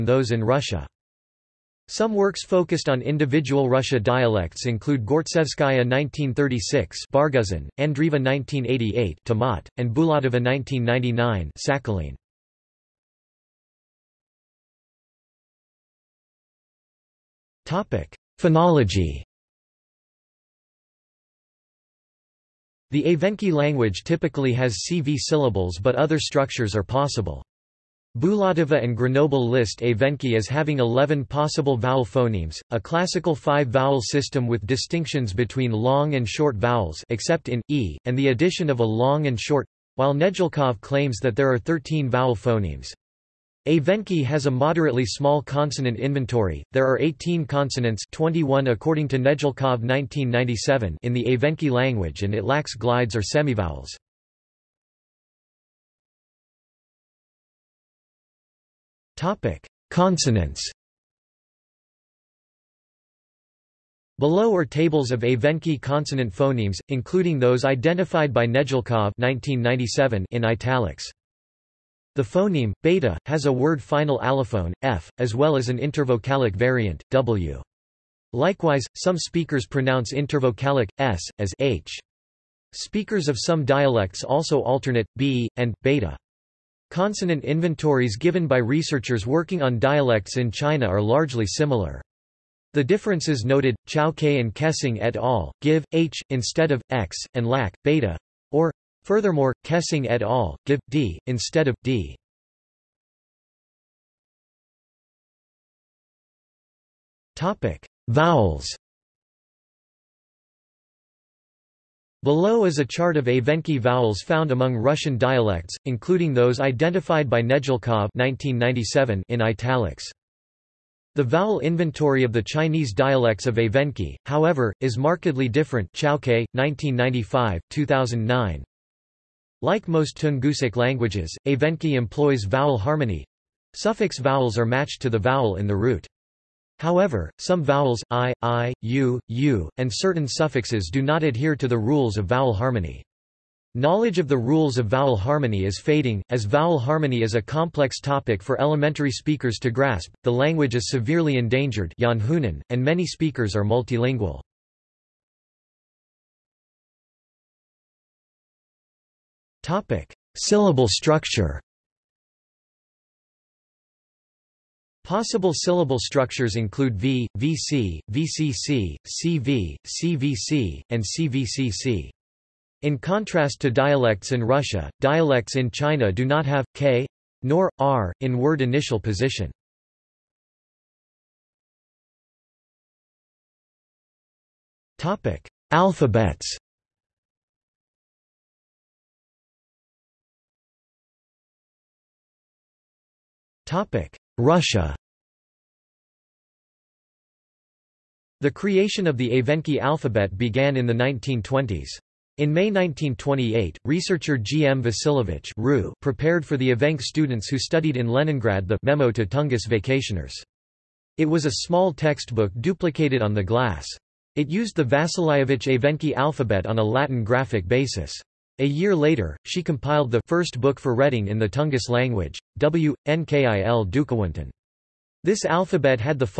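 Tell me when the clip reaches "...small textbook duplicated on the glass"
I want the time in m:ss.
3:31.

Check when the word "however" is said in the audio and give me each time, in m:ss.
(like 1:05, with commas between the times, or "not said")
2:04, 2:16.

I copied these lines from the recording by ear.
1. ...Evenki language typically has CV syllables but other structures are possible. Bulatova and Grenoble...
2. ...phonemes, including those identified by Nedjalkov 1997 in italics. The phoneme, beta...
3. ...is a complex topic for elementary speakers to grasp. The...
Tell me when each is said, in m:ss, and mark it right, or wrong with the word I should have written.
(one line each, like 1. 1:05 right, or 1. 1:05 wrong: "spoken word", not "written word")
1. 0:23 right
2. 1:06 right
3. 2:27 right.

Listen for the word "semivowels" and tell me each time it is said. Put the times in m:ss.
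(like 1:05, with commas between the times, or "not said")
0:53.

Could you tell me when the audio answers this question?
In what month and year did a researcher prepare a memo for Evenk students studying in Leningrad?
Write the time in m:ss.
3:22.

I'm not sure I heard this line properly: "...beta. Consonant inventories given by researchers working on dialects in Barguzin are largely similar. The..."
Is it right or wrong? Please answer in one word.
wrong.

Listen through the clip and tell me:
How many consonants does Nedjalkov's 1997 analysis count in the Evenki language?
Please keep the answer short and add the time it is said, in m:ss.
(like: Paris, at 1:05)
21, at 0:48.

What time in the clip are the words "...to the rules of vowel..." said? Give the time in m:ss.
2:21.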